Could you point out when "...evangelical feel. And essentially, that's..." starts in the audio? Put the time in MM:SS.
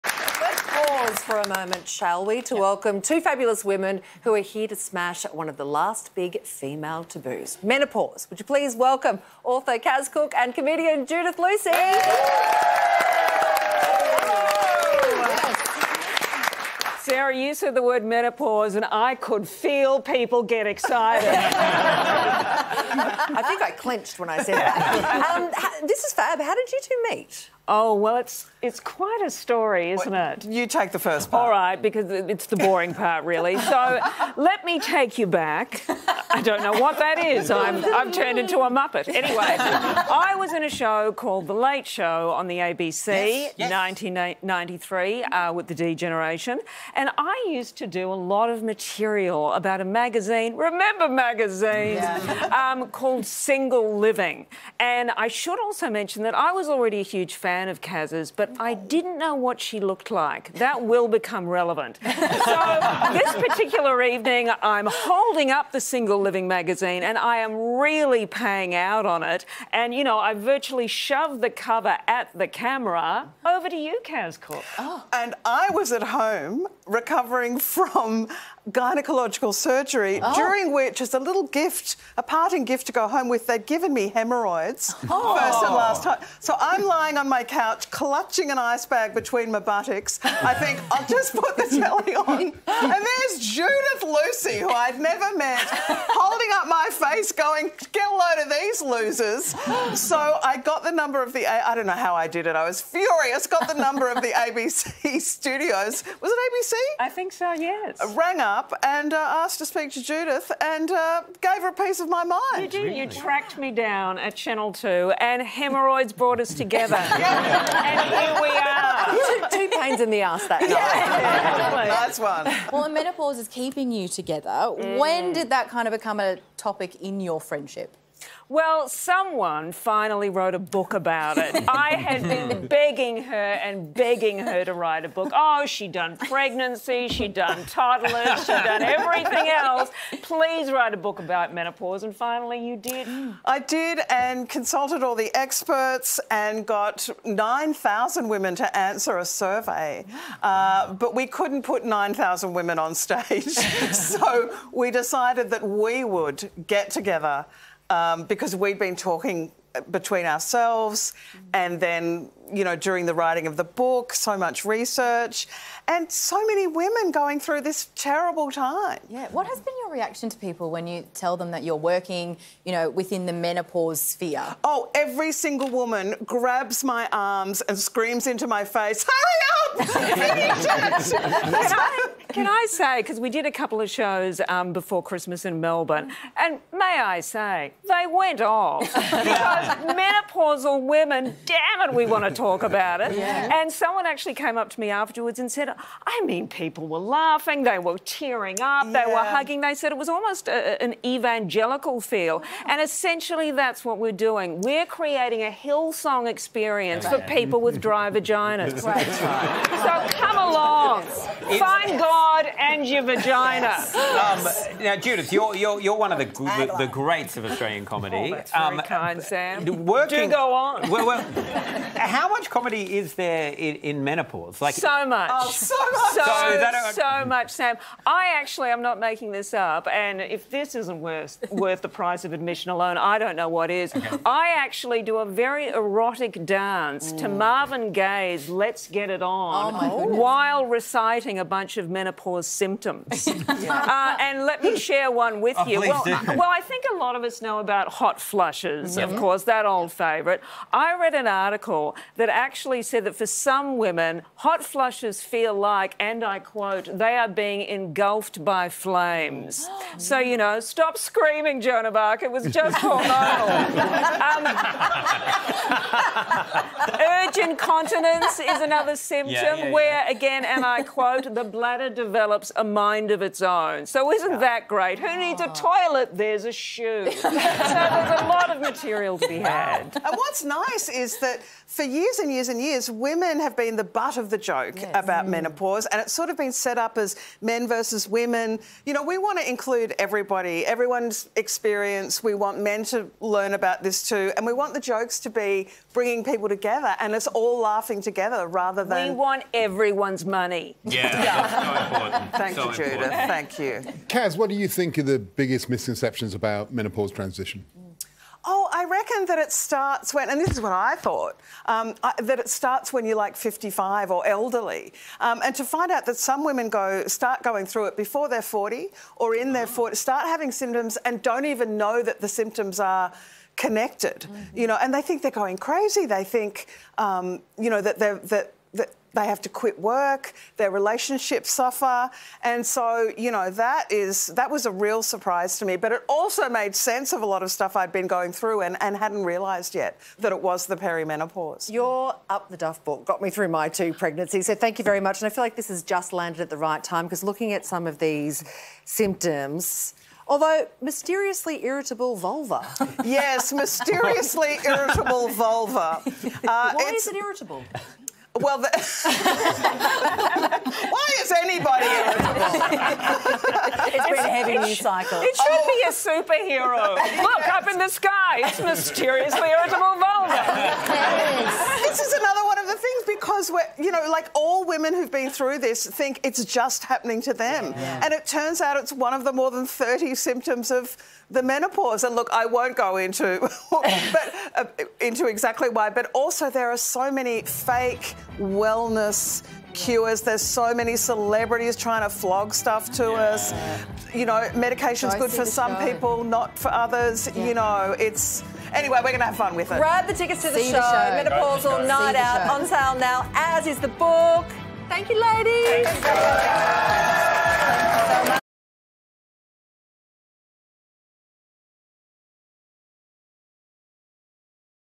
03:21.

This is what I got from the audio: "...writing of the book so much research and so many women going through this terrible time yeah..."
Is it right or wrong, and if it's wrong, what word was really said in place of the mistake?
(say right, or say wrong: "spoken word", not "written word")
right.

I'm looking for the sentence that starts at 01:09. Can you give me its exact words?
And, you know, I virtually shoved the cover at the camera.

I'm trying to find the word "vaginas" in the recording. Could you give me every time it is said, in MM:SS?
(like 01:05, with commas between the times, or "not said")
03:28, 03:33.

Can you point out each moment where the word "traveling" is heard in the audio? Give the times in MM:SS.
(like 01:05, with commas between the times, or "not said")
not said.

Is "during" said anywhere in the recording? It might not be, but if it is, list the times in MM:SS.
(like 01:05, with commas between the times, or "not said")
01:20, 02:42.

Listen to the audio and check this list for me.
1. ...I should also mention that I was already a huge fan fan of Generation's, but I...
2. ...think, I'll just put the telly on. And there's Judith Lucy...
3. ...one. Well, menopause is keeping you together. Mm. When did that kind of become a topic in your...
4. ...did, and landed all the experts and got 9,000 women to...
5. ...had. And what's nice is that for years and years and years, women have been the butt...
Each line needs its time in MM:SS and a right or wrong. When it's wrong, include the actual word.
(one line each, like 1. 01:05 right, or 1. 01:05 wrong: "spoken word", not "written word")
1. 00:55 wrong: "Kaz", not "Generation"
2. 01:30 right
3. 02:02 right
4. 02:23 wrong: "consulted", not "landed"
5. 04:39 right.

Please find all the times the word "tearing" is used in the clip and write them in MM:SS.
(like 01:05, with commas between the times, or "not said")
03:17.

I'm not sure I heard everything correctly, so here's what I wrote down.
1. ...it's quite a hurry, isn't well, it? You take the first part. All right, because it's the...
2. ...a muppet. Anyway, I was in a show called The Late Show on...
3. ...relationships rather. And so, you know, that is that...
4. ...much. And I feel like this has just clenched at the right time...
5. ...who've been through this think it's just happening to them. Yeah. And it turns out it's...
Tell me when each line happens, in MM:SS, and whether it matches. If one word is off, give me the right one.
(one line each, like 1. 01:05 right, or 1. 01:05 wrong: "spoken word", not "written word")
1. 00:28 wrong: "story", not "hurry"
2. 00:38 right
3. 05:30 wrong: "suffer", not "rather"
4. 05:45 wrong: "landed", not "clenched"
5. 06:14 right.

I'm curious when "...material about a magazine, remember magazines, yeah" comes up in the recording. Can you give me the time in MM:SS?
00:48.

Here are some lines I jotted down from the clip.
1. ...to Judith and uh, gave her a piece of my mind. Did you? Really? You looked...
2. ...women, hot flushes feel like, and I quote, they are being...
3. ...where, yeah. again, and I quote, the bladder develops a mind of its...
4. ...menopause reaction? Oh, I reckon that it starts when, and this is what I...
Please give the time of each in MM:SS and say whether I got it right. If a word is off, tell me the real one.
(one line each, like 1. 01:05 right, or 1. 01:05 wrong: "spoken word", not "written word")
1. 01:49 wrong: "tracked", not "looked"
2. 04:13 right
3. 04:29 right
4. 05:06 wrong: "transition", not "reaction".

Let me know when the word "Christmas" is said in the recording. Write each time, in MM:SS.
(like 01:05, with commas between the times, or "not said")
03:05.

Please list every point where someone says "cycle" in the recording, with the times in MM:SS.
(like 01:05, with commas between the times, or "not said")
06:04.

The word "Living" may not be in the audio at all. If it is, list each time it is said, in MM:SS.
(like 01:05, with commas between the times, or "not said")
00:53, 01:06.